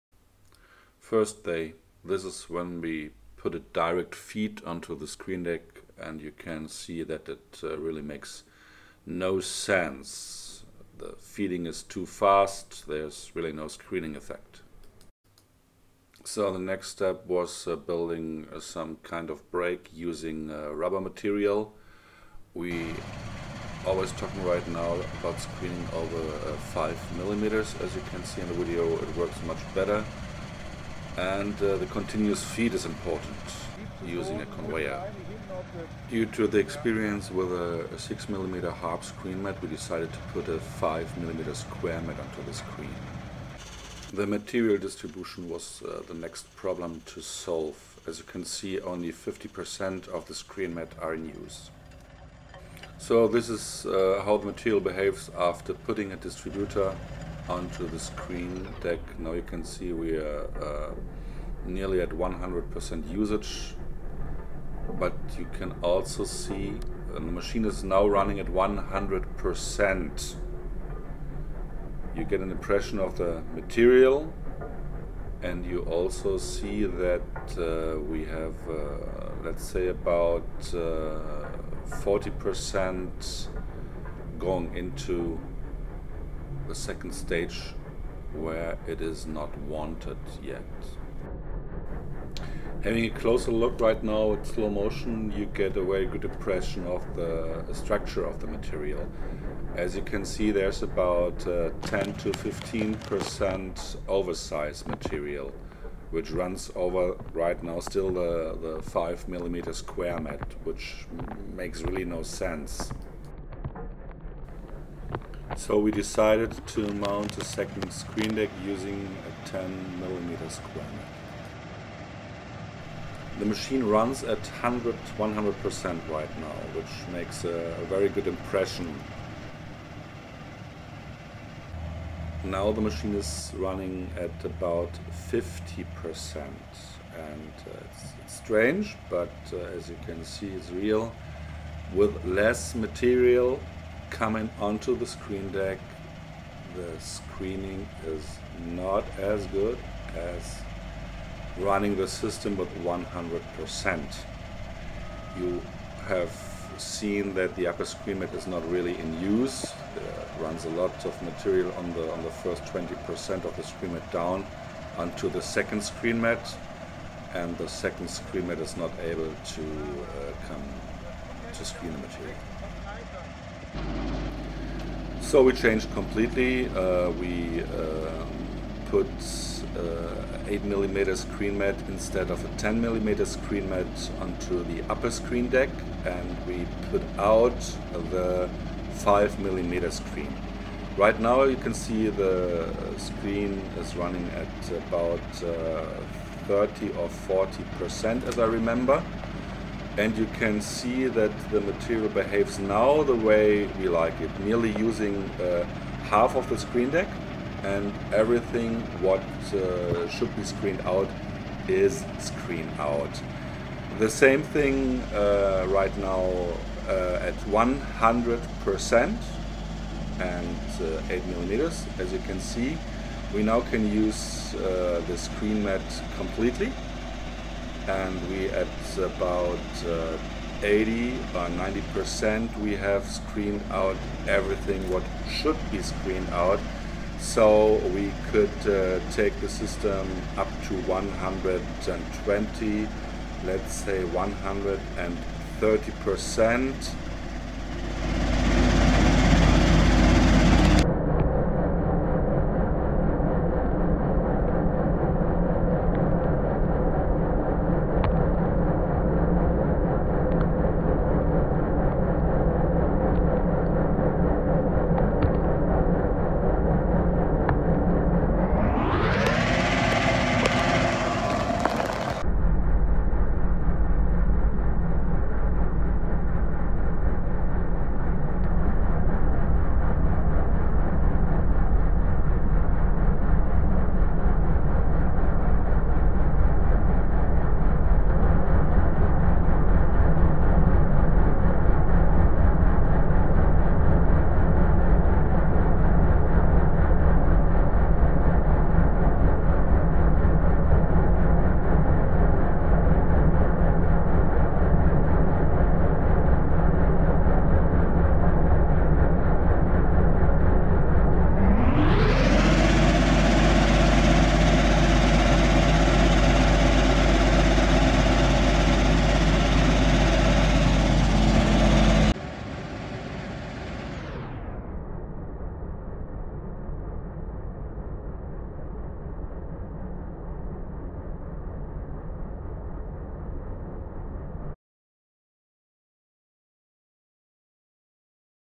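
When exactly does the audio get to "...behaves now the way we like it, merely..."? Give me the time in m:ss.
3:22.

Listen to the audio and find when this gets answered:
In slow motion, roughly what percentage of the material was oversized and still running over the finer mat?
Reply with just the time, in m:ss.
1:41.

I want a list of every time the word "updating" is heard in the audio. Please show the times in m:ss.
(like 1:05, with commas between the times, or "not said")
not said.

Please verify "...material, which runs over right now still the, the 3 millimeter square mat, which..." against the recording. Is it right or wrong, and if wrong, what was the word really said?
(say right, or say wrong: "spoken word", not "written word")
wrong: "5", not "3".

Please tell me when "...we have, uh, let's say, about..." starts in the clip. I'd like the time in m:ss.
1:17.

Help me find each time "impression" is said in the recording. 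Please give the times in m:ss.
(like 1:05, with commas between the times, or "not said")
1:12, 1:36, 2:08.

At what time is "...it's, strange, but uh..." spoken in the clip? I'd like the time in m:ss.
2:18.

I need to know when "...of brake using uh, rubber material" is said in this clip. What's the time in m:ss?
0:19.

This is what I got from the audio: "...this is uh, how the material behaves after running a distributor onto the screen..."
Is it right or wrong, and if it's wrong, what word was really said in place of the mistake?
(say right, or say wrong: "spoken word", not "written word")
wrong: "putting", not "running".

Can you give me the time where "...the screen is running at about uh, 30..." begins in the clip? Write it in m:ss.
3:12.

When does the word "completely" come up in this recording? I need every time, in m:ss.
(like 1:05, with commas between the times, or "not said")
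2:55, 3:46.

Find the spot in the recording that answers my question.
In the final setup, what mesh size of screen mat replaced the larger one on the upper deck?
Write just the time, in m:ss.
3:00.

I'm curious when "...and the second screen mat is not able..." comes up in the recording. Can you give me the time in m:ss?
2:47.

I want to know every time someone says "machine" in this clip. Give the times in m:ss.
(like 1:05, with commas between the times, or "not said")
1:07, 2:03, 2:12.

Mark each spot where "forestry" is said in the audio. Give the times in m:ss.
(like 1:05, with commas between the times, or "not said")
not said.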